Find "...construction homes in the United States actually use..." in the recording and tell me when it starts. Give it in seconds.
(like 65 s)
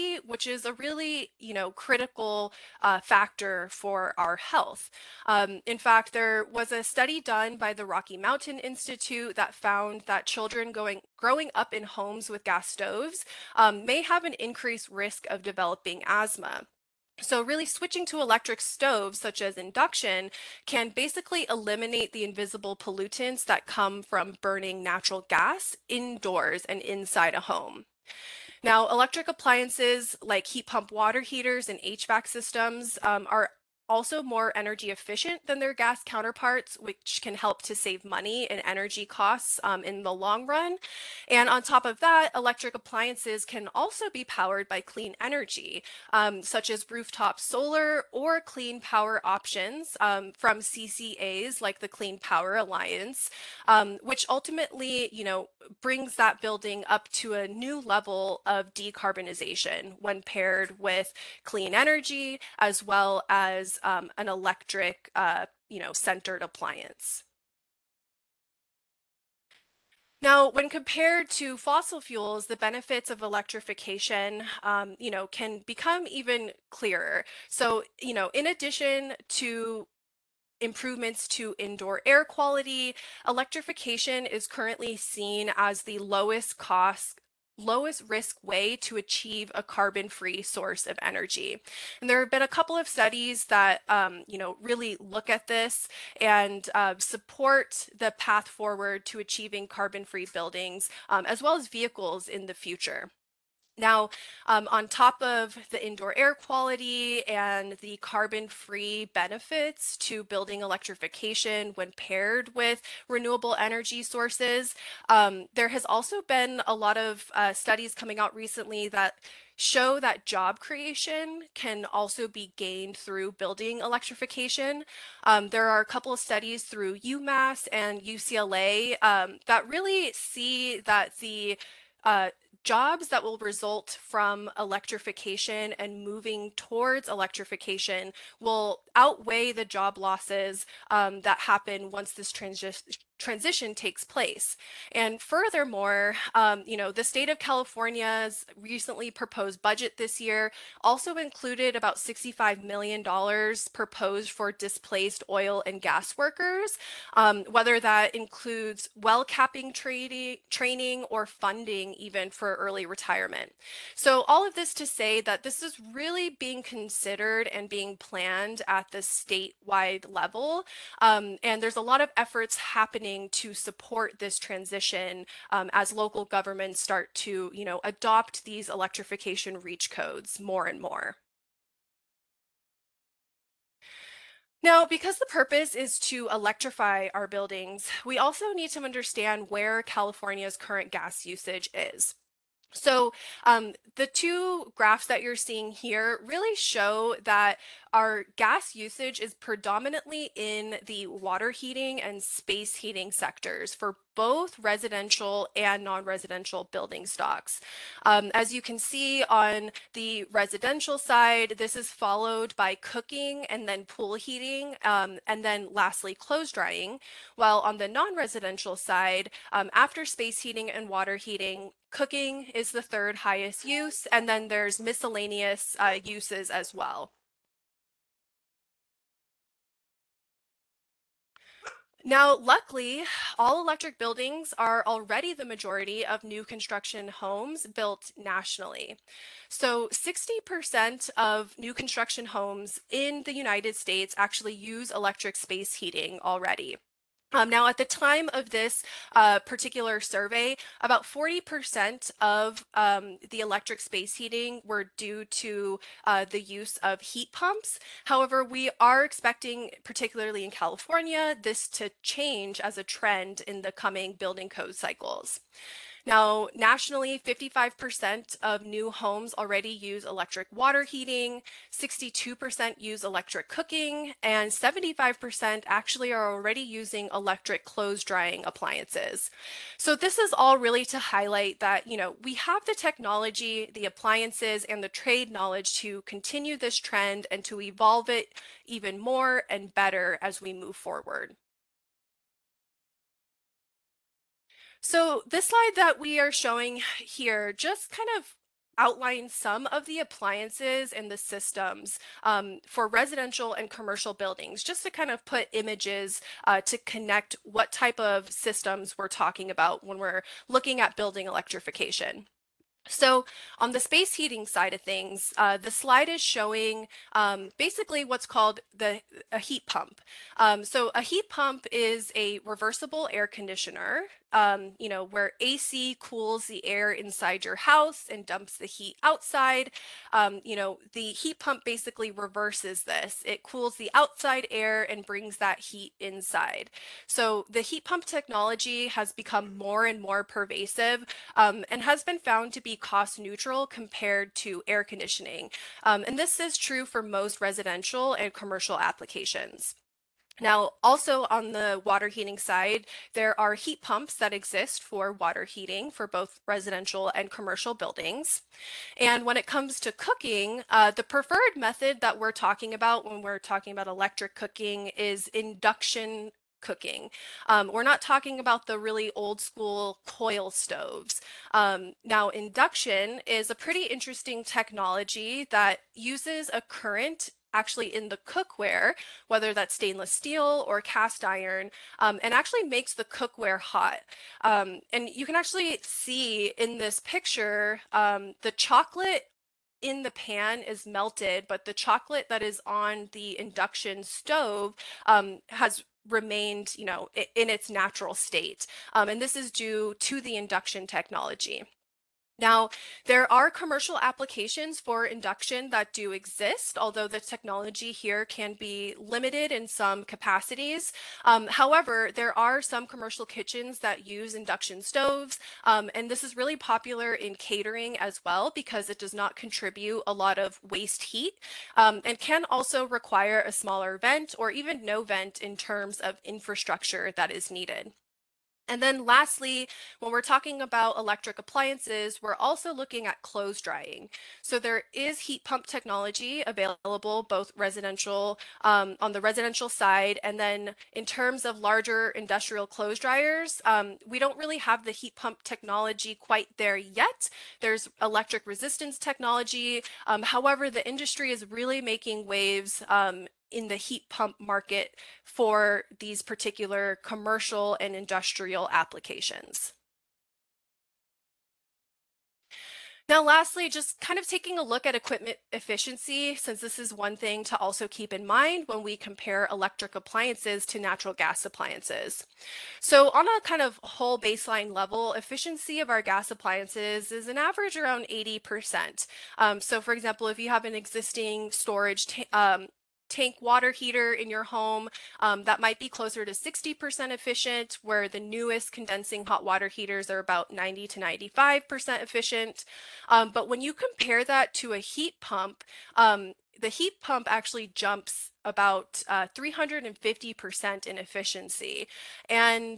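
241 s.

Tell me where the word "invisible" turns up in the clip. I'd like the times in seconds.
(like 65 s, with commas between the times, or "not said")
22 s.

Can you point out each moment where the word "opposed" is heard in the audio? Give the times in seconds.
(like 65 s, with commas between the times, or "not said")
not said.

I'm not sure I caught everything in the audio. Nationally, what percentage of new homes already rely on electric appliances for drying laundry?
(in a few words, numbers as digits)
75%.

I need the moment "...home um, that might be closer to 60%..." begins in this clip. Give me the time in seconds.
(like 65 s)
484 s.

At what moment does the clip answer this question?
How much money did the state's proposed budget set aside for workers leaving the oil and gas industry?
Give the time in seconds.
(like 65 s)
151 s.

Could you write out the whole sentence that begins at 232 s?
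Now, luckily, all electric buildings are already the majority of new construction homes built nationally.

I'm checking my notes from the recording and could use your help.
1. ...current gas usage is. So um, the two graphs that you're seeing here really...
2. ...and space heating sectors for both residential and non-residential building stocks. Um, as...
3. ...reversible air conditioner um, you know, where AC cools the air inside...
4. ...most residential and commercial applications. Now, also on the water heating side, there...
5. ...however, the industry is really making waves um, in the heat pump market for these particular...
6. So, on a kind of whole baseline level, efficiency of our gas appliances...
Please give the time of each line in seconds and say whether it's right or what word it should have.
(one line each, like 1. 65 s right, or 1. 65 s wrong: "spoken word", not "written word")
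1. 190 s right
2. 202 s right
3. 322 s right
4. 347 s right
5. 450 s right
6. 472 s right.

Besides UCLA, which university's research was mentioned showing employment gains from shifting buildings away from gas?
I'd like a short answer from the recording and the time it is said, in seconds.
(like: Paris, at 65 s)
UMass, at 126 s.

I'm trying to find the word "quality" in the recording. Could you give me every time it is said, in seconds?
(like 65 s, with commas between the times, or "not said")
82 s, 106 s.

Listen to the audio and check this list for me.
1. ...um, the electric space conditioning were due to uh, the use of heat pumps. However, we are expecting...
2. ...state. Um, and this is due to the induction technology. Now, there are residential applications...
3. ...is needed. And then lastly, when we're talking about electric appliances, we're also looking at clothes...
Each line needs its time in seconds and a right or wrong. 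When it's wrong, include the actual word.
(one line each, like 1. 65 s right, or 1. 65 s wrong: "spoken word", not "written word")
1. 252 s wrong: "heating", not "conditioning"
2. 398 s wrong: "commercial", not "residential"
3. 427 s right.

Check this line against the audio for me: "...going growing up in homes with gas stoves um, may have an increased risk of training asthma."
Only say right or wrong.
wrong.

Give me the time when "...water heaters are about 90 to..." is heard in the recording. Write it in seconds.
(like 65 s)
489 s.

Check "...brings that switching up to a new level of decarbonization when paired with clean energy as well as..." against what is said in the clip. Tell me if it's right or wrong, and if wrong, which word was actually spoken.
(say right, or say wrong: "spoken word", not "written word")
wrong: "building", not "switching".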